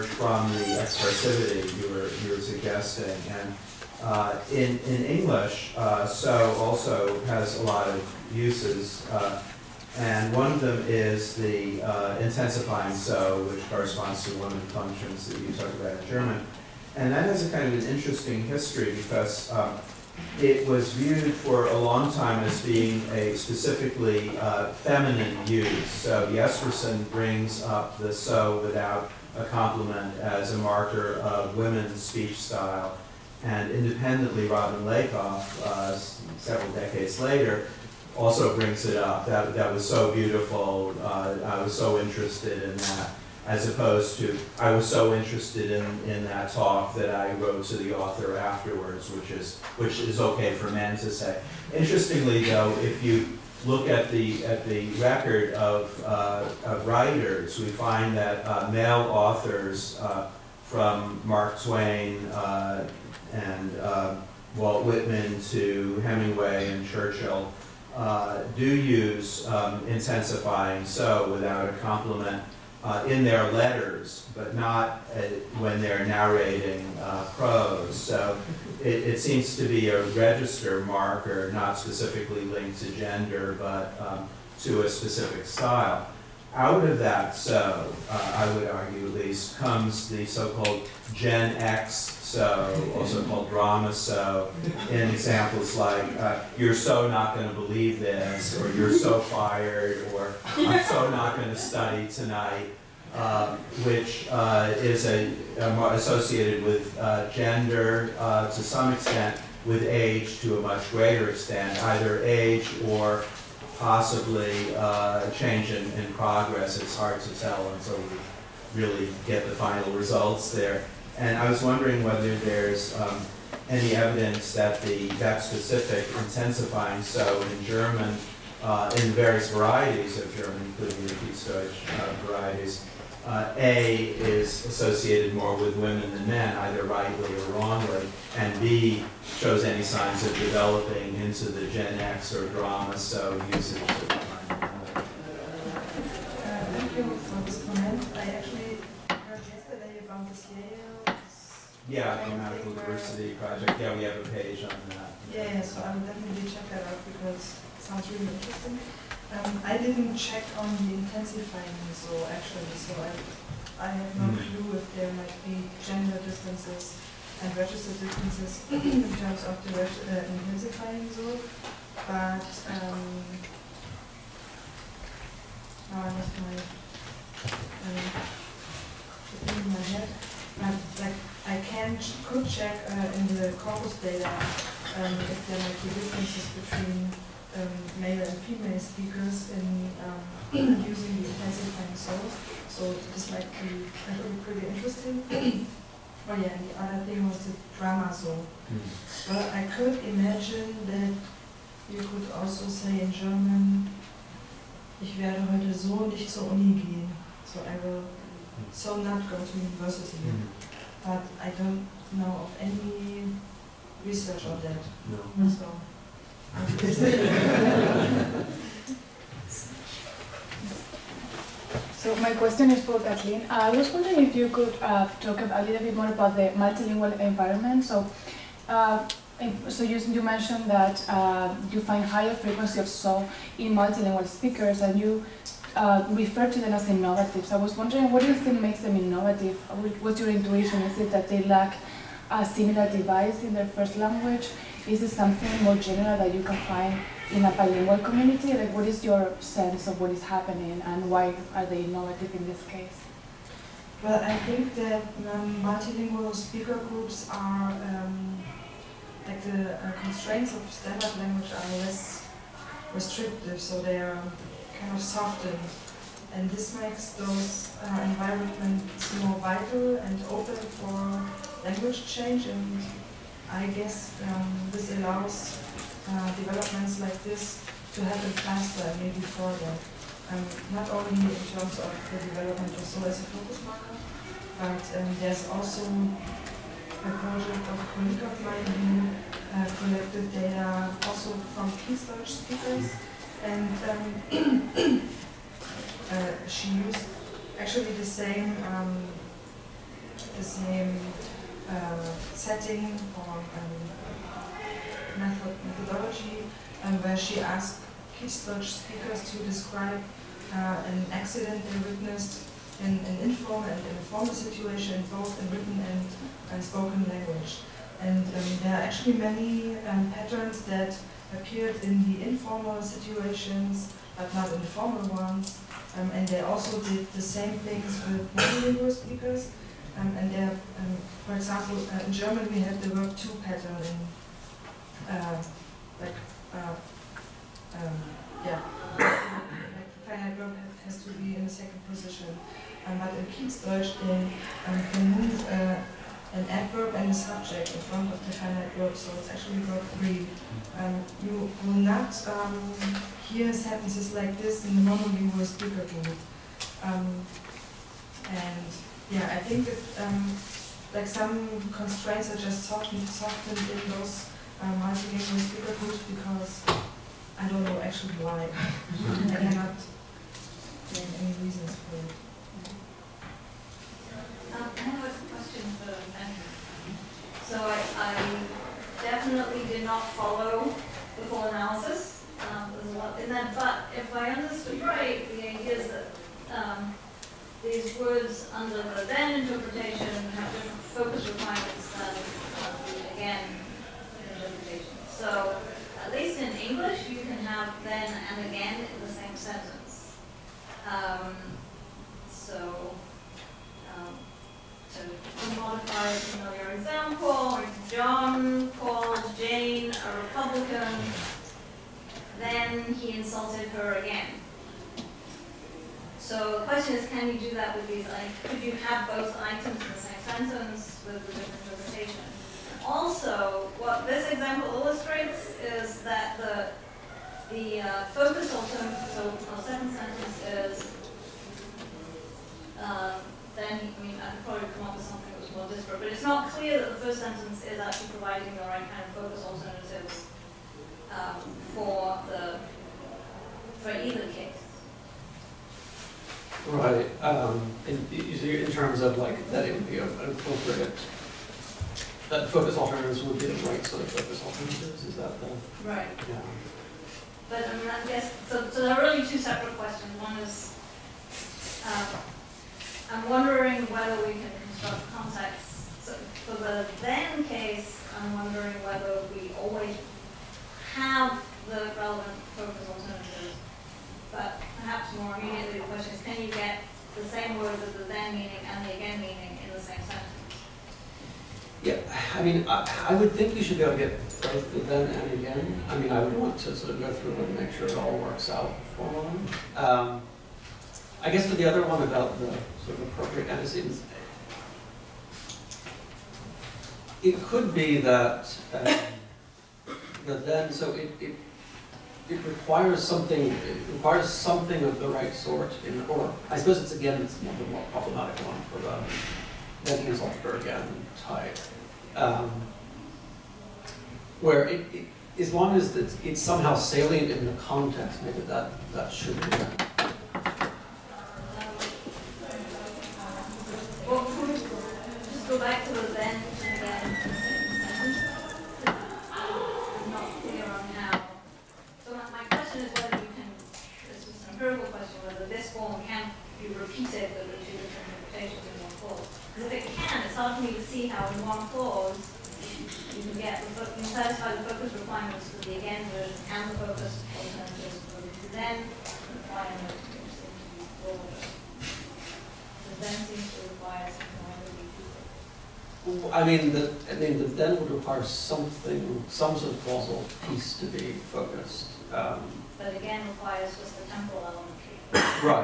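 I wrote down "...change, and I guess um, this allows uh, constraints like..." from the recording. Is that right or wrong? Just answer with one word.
wrong.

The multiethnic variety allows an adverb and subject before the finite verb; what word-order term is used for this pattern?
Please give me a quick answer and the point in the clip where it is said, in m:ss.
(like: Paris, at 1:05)
verb three, at 5:49.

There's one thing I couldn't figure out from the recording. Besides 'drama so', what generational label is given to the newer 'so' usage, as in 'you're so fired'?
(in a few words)
Gen X so.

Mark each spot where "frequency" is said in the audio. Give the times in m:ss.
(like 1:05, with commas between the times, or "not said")
3:52.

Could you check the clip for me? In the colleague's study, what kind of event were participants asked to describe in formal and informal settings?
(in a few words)
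an accident.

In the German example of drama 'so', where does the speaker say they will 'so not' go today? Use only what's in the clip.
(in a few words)
university.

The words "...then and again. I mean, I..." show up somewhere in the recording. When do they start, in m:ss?
8:04.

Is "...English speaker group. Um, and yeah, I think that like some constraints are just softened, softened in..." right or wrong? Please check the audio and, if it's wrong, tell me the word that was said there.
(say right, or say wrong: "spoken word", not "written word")
right.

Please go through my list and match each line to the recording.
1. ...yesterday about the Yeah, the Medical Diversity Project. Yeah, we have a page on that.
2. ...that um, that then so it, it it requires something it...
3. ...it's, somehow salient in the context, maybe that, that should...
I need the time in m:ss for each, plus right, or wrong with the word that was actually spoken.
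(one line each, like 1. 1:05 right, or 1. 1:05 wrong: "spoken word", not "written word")
1. 2:29 right
2. 8:17 right
3. 8:36 right.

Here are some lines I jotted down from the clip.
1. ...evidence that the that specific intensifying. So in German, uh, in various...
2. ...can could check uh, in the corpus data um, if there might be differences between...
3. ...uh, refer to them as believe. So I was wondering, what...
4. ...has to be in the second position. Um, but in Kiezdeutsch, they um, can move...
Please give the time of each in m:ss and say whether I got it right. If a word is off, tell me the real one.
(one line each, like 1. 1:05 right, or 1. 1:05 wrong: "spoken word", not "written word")
1. 2:03 right
2. 3:01 right
3. 3:55 wrong: "innovative", not "believe"
4. 5:40 right.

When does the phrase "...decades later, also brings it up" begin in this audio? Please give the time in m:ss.
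0:36.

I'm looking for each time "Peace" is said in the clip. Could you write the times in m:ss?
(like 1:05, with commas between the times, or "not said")
4:51.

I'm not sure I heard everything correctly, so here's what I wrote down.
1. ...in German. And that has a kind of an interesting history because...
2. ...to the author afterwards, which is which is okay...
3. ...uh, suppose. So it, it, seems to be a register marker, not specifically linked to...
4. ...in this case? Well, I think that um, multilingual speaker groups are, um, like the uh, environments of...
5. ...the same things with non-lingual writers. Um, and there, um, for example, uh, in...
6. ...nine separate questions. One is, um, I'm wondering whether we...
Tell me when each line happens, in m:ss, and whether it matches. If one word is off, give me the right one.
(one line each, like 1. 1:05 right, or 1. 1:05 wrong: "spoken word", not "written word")
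1. 0:16 right
2. 0:47 right
3. 1:17 wrong: "prose", not "suppose"
4. 4:12 wrong: "constraints", not "environments"
5. 5:27 wrong: "speakers", not "writers"
6. 7:39 wrong: "two", not "nine".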